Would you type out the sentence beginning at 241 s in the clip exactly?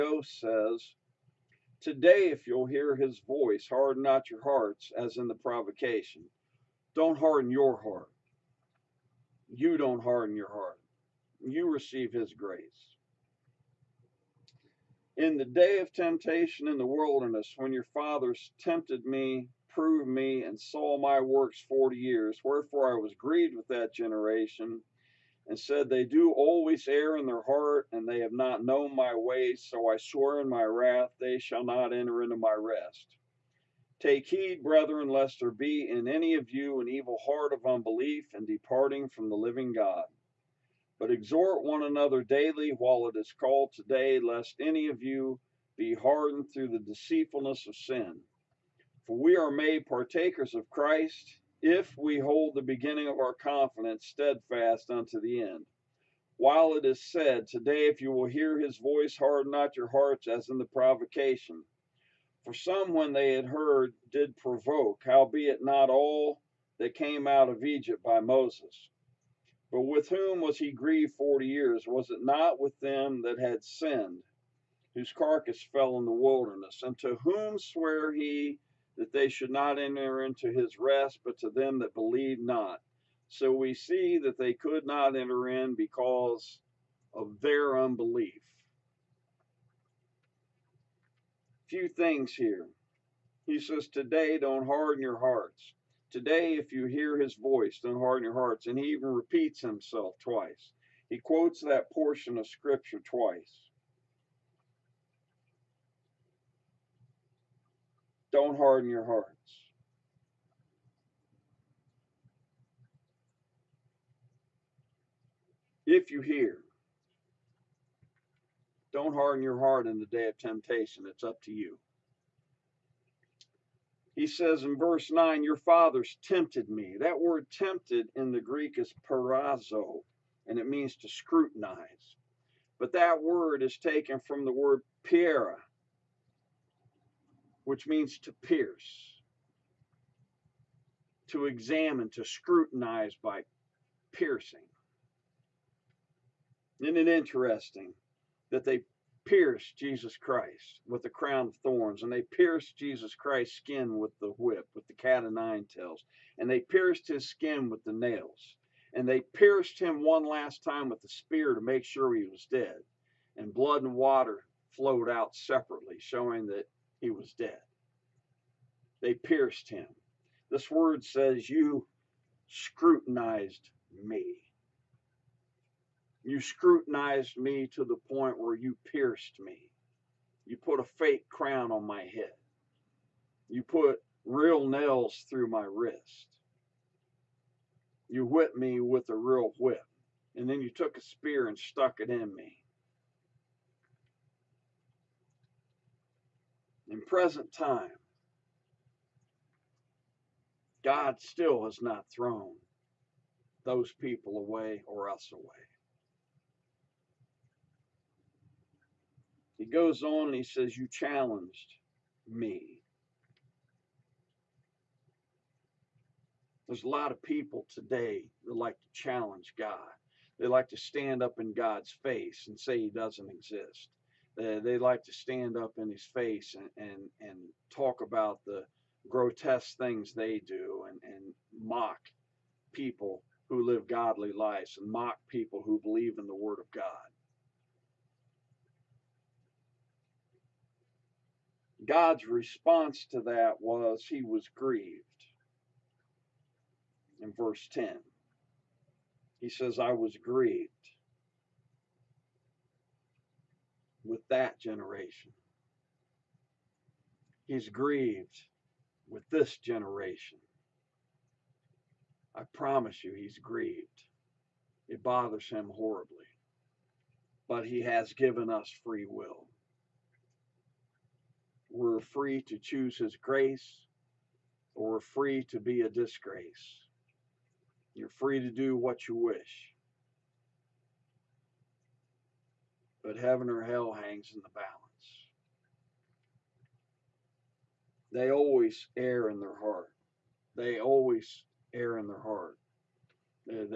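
God's response to that was he was grieved.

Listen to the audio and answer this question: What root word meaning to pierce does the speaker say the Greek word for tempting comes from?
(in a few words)
piera.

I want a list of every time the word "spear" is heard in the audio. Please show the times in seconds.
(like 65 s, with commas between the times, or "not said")
161 s, 191 s.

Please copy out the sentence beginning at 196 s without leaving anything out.
in present time, God still has not thrown those people away or us away.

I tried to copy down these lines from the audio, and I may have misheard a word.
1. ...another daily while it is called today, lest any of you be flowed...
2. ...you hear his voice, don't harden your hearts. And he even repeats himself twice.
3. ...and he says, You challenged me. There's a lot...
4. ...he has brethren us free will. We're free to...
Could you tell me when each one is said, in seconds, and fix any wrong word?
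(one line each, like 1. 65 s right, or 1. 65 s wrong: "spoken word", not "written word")
1. 41 s wrong: "hardened", not "flowed"
2. 96 s right
3. 210 s right
4. 267 s wrong: "given", not "brethren".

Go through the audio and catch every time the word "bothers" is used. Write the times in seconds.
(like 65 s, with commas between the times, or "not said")
265 s.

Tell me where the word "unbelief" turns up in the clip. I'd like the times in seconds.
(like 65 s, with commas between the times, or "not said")
37 s, 87 s.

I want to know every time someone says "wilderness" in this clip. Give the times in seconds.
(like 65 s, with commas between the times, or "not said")
16 s, 76 s.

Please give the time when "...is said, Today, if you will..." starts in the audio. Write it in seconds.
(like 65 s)
56 s.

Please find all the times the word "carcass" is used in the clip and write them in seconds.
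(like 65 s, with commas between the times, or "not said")
75 s.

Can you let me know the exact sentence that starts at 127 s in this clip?
That word tempted in the Greek is peirazo, and it means to scrutinize.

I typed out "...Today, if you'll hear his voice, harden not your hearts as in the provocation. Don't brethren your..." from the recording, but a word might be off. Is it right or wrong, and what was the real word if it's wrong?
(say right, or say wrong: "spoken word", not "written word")
wrong: "harden", not "brethren".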